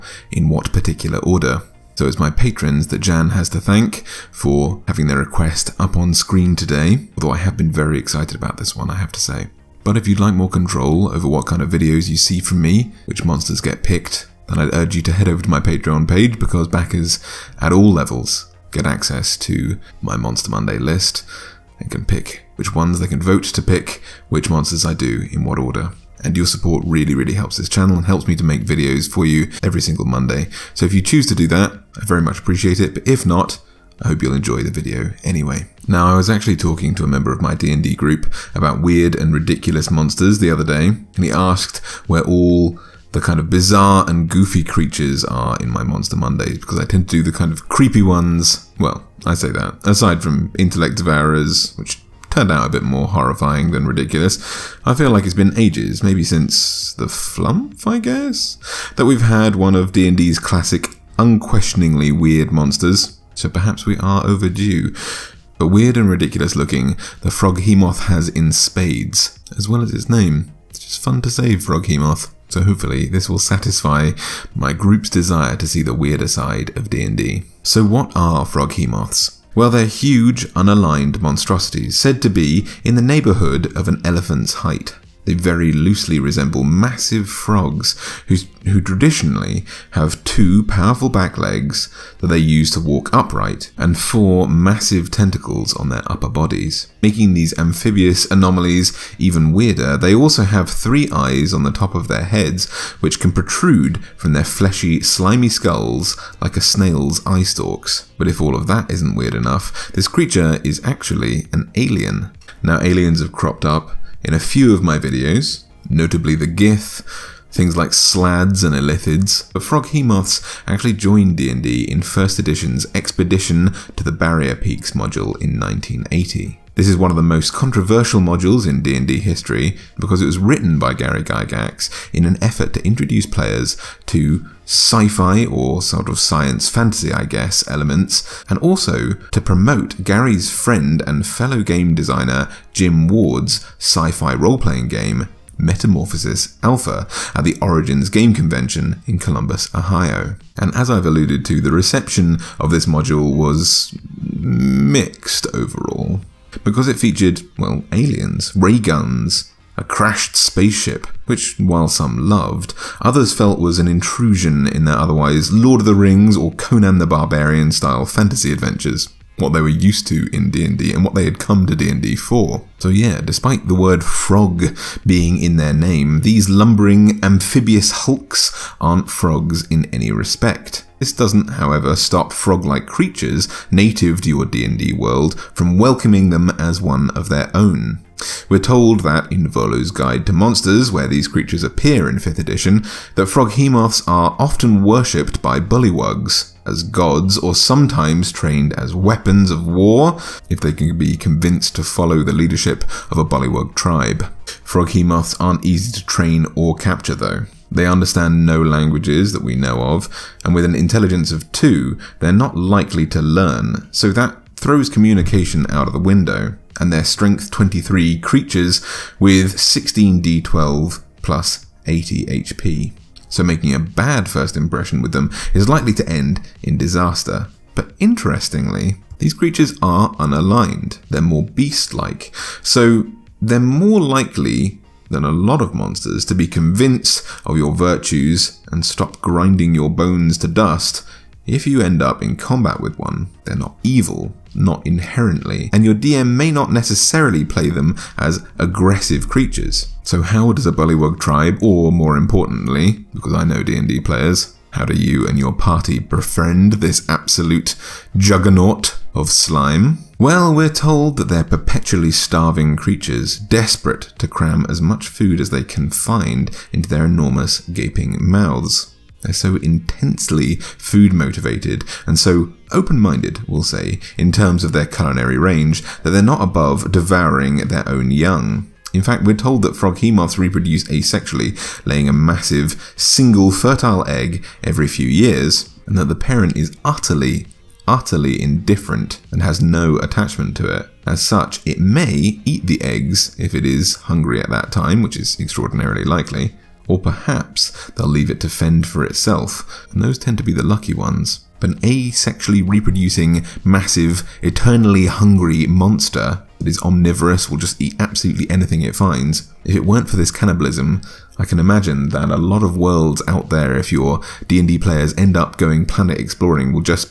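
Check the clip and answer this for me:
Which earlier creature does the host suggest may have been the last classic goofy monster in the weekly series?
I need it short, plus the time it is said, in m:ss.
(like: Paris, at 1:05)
The flump, at 0:56.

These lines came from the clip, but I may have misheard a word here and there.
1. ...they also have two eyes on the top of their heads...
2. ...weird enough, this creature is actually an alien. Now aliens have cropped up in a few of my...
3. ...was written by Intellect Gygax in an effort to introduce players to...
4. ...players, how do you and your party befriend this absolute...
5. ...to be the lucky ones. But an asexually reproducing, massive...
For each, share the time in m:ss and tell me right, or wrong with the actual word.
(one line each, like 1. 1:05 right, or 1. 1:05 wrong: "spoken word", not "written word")
1. 1:39 wrong: "three", not "two"
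2. 1:49 right
3. 2:10 wrong: "Gary", not "Intellect"
4. 4:14 right
5. 5:00 right.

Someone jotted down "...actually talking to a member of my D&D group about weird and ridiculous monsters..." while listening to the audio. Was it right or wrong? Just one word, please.
right.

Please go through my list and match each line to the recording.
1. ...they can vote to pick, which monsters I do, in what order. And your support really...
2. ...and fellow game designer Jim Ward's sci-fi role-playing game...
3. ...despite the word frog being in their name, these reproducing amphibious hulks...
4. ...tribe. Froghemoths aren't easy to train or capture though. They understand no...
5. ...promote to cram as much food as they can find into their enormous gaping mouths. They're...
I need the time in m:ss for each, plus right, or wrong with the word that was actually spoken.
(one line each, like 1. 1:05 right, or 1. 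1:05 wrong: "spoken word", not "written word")
1. 0:22 right
2. 2:21 right
3. 2:53 wrong: "lumbering", not "reproducing"
4. 3:23 right
5. 4:23 wrong: "desperate", not "promote".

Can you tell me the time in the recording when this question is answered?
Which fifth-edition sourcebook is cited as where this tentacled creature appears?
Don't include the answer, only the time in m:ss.
3:09.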